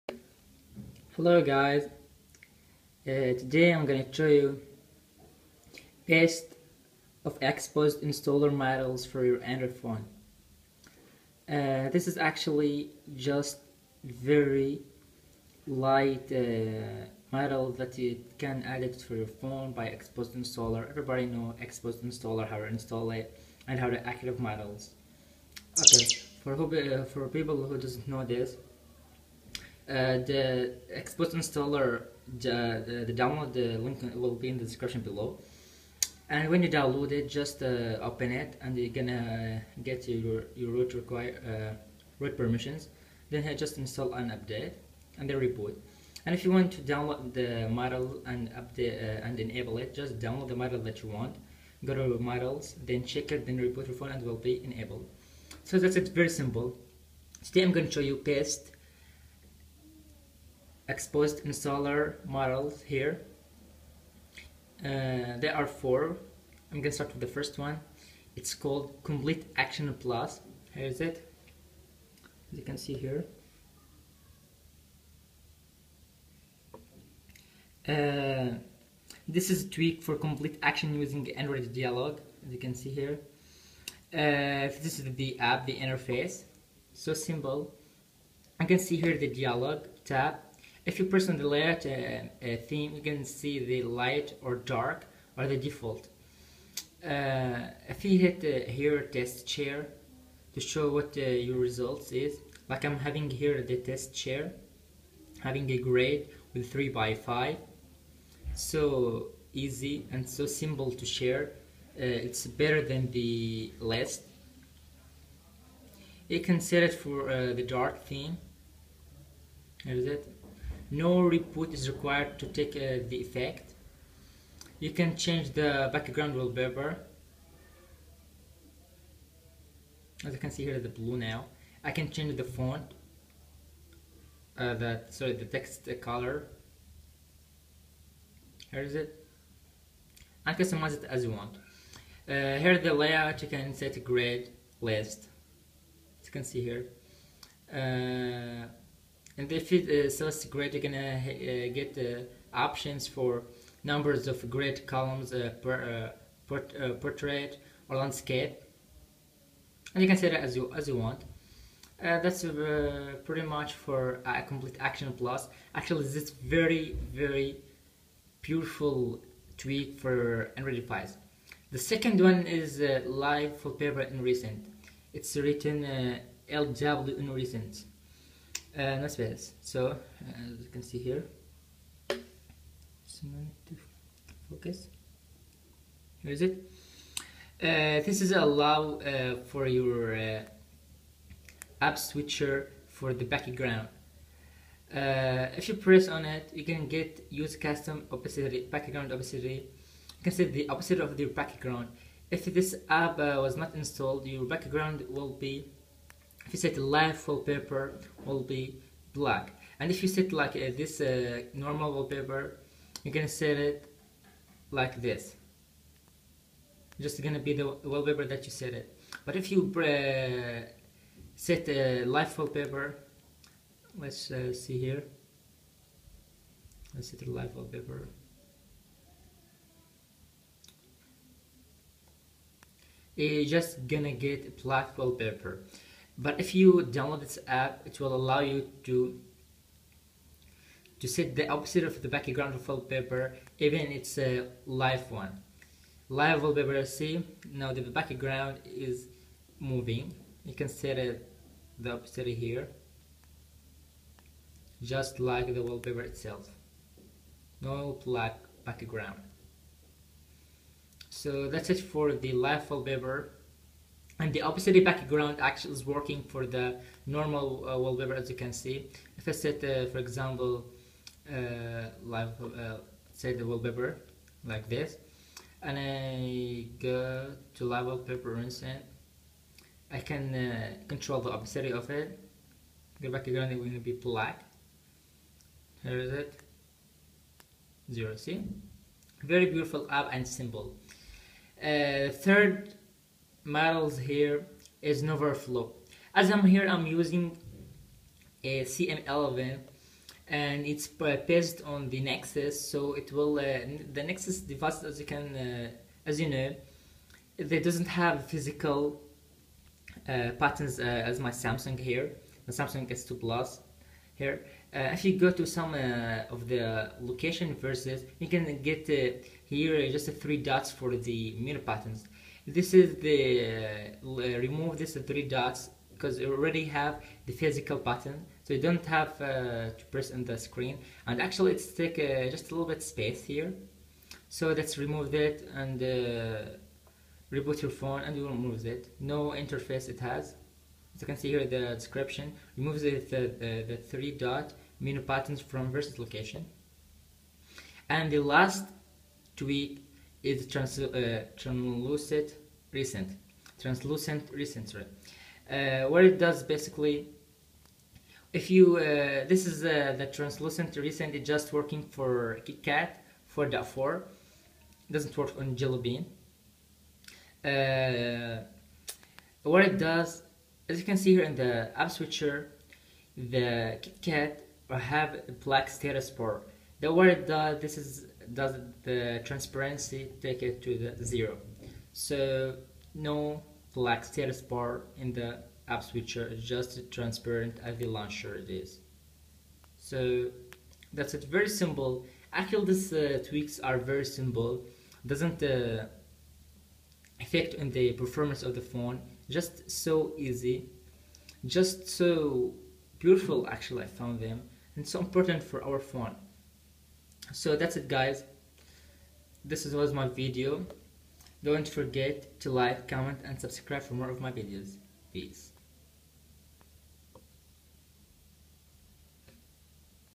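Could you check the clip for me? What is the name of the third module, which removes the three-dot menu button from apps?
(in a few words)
No Overflow.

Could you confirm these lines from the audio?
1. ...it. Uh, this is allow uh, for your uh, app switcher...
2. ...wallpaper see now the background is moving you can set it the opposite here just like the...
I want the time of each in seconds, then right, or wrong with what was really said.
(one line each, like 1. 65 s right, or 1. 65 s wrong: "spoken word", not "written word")
1. 186 s right
2. 246 s right.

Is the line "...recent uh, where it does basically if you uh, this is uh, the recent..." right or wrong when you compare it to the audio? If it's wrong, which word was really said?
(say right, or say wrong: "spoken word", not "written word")
wrong: "translucent", not "recent".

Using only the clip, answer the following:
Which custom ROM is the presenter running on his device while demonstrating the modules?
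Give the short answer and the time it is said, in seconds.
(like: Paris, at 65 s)
CM11, at 298 s.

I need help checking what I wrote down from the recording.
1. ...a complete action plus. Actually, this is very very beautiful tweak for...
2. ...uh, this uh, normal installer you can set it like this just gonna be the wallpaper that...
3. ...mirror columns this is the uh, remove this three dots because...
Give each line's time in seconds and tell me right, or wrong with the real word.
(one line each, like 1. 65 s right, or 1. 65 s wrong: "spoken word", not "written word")
1. 164 s right
2. 210 s wrong: "wallpaper", not "installer"
3. 321 s wrong: "patterns", not "columns".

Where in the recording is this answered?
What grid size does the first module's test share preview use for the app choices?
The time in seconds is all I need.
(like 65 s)
106 s.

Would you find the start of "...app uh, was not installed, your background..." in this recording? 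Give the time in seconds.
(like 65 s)
202 s.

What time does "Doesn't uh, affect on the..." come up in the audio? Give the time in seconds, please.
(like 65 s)
395 s.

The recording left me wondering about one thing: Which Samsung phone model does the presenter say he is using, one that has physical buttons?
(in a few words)
Samsung S2 Plus.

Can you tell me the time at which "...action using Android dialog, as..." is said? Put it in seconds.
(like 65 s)
80 s.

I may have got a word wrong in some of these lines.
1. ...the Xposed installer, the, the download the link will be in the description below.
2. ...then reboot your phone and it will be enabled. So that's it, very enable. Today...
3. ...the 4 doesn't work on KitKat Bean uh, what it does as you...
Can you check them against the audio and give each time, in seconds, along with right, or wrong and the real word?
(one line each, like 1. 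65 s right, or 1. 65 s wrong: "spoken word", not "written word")
1. 30 s right
2. 53 s wrong: "simple", not "enable"
3. 363 s wrong: "Jelly", not "KitKat".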